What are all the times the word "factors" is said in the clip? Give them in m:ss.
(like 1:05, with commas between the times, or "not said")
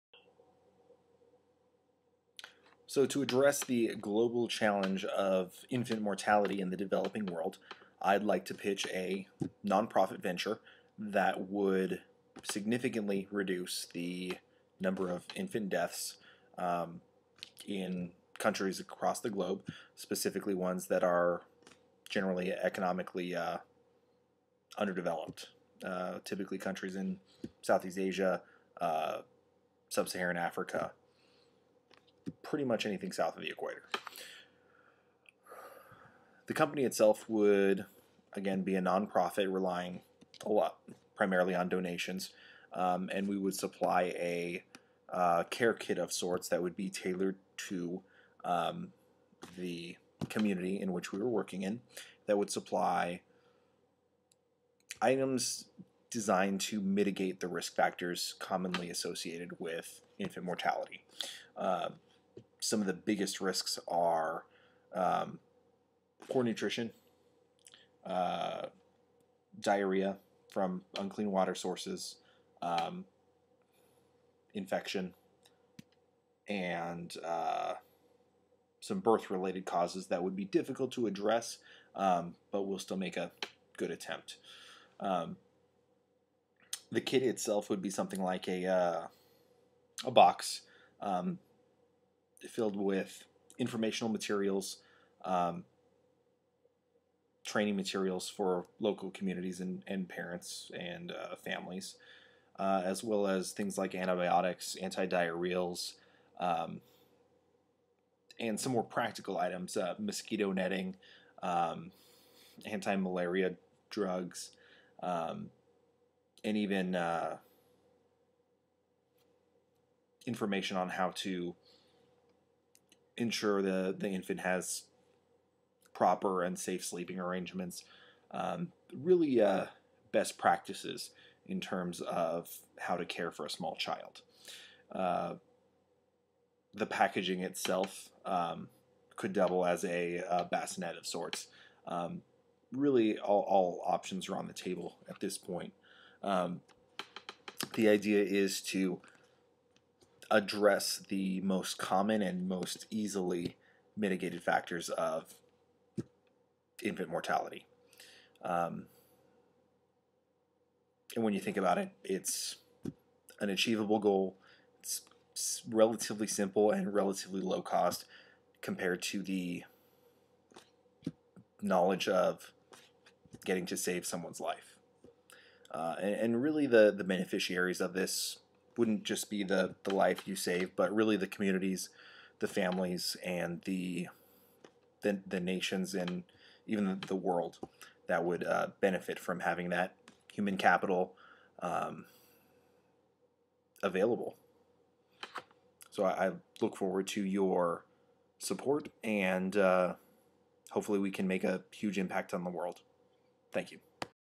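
0:57, 2:34.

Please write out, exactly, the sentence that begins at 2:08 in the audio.
Um, really, uh, best practices in terms of how to care for a small child.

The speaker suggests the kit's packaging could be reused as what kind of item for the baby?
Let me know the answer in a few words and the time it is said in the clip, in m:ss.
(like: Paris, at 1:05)
a bassinet, at 2:20.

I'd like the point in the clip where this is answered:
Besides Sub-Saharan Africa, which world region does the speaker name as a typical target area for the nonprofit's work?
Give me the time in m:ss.
0:27.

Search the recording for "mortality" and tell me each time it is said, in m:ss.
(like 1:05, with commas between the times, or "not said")
0:06, 1:00, 2:37.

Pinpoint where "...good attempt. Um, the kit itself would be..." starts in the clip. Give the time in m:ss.
1:23.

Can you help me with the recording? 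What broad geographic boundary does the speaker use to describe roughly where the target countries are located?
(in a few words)
south of the equator.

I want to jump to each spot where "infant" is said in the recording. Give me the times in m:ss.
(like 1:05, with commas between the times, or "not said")
0:05, 0:15, 1:00, 2:04, 2:36.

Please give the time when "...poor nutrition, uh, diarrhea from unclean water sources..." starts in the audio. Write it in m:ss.
1:06.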